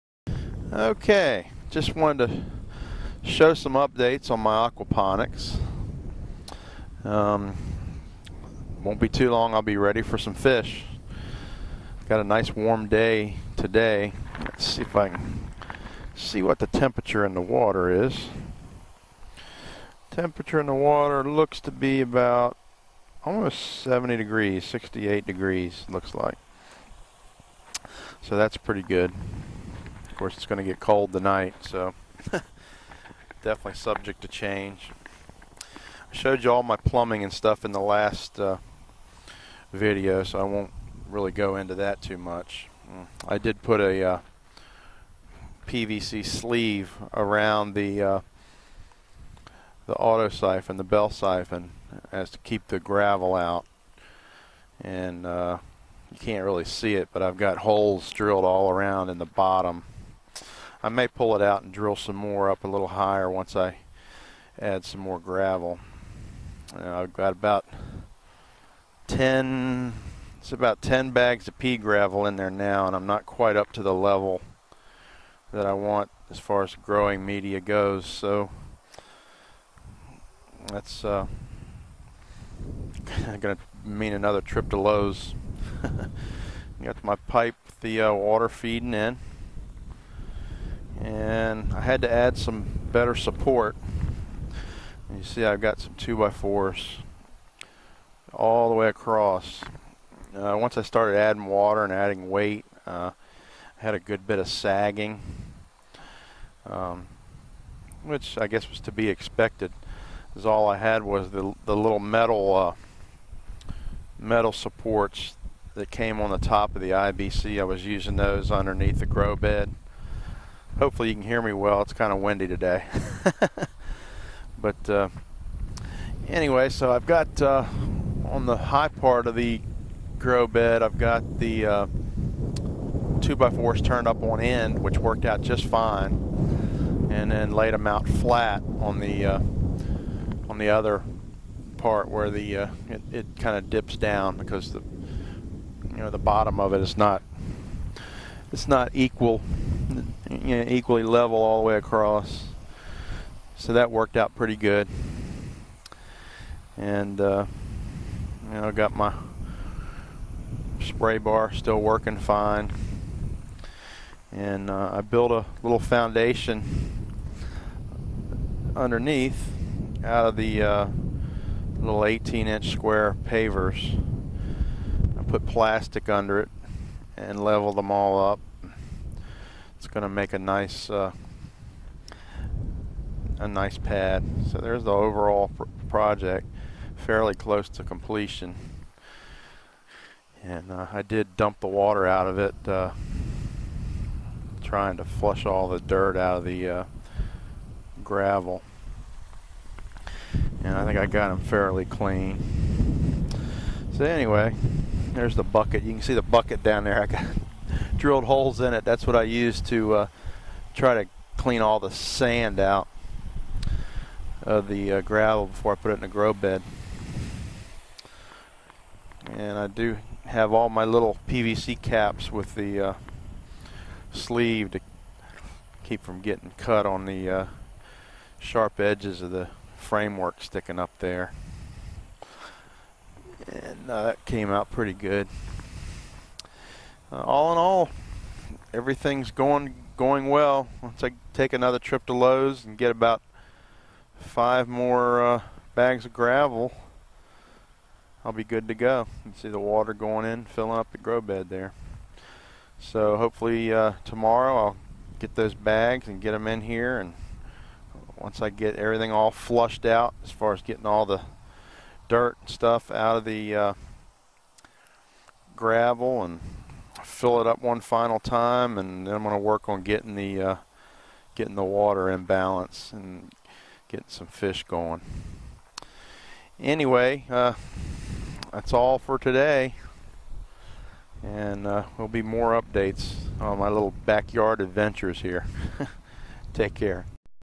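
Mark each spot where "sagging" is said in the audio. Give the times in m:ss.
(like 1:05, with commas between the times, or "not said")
1:44.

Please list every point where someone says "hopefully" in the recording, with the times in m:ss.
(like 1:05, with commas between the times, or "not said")
2:00, 4:13.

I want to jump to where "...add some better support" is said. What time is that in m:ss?
1:32.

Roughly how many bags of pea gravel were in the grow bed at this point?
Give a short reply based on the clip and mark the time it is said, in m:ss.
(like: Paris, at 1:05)
10, at 1:10.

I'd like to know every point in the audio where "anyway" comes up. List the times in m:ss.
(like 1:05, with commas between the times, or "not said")
2:06, 3:24, 4:36.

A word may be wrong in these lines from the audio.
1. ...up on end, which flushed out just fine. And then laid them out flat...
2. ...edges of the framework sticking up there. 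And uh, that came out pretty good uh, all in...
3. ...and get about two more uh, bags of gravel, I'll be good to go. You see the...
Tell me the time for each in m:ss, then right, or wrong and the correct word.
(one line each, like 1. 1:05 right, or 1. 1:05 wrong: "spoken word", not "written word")
1. 2:14 wrong: "worked", not "flushed"
2. 3:48 right
3. 4:02 wrong: "five", not "two".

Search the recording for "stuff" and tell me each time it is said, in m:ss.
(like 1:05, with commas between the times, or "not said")
0:37, 4:22.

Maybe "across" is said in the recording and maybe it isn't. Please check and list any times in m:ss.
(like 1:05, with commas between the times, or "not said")
1:38, 2:31.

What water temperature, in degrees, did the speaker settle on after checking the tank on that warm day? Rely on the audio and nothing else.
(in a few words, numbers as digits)
68.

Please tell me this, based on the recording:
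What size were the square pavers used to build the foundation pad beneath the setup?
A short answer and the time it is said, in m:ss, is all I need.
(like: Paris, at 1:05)
18 inch, at 2:52.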